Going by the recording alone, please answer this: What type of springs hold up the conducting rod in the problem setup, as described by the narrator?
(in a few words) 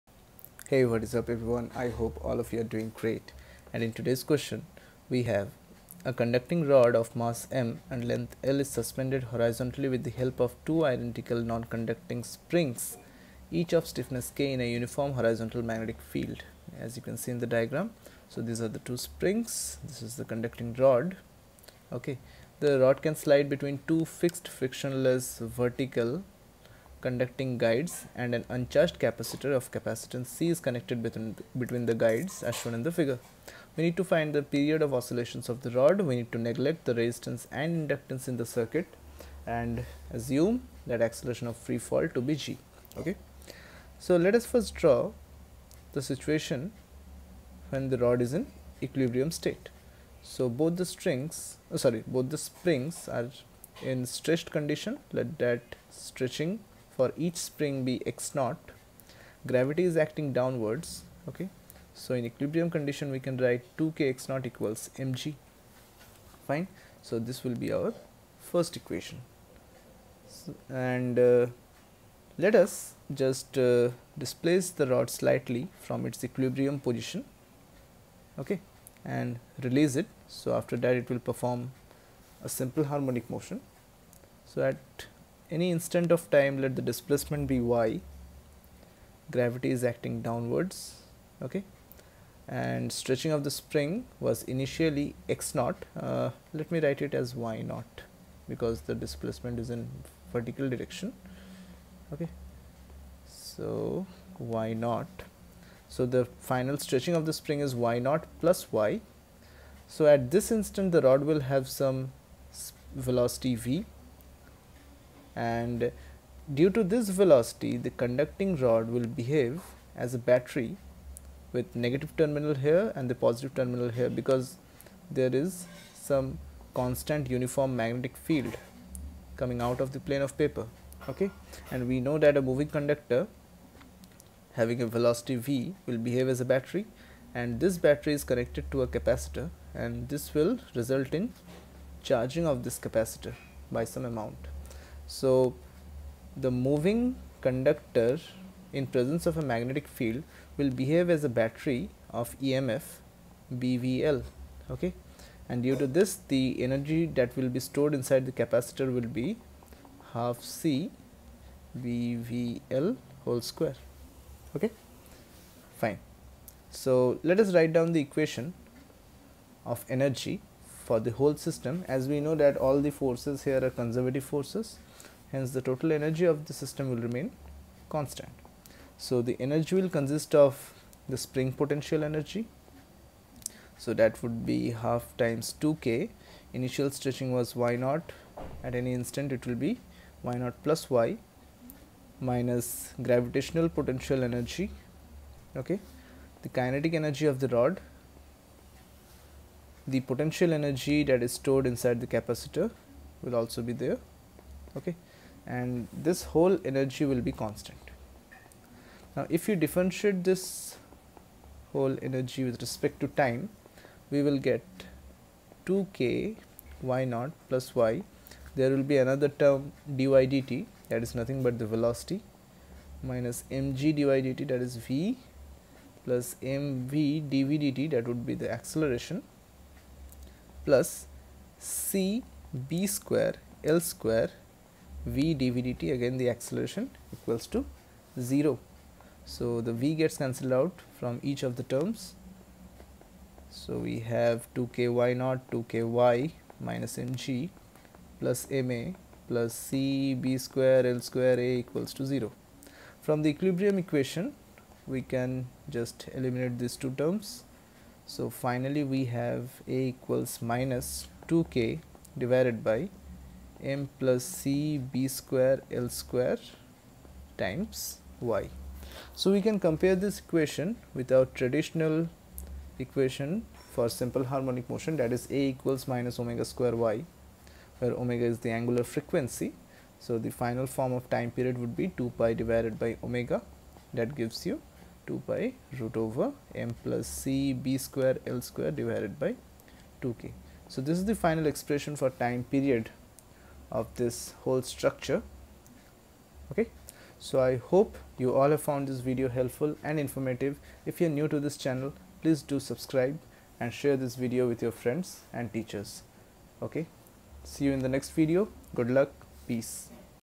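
Non-conducting springs.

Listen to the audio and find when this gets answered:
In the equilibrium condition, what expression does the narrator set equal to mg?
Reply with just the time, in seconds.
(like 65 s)
63 s.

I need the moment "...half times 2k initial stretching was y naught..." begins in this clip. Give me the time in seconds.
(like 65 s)
184 s.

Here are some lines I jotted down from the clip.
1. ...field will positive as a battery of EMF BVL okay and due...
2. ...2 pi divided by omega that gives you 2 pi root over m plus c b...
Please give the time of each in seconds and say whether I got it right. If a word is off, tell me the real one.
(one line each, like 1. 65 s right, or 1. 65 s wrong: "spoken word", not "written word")
1. 149 s wrong: "behave", not "positive"
2. 281 s right.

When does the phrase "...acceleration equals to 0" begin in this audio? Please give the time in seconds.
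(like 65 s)
236 s.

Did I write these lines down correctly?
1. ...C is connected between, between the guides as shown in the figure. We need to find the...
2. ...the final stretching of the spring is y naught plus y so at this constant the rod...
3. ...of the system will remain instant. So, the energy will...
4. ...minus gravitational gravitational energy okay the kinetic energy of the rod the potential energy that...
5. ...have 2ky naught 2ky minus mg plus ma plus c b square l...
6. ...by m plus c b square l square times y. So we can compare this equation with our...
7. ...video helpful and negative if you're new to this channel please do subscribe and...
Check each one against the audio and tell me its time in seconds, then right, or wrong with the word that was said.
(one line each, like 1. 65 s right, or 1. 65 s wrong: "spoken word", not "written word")
1. 30 s right
2. 106 s wrong: "instant", not "constant"
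3. 176 s wrong: "constant", not "instant"
4. 192 s wrong: "potential", not "gravitational"
5. 244 s right
6. 262 s right
7. 298 s wrong: "informative", not "negative".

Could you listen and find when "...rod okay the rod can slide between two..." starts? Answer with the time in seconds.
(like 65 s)
20 s.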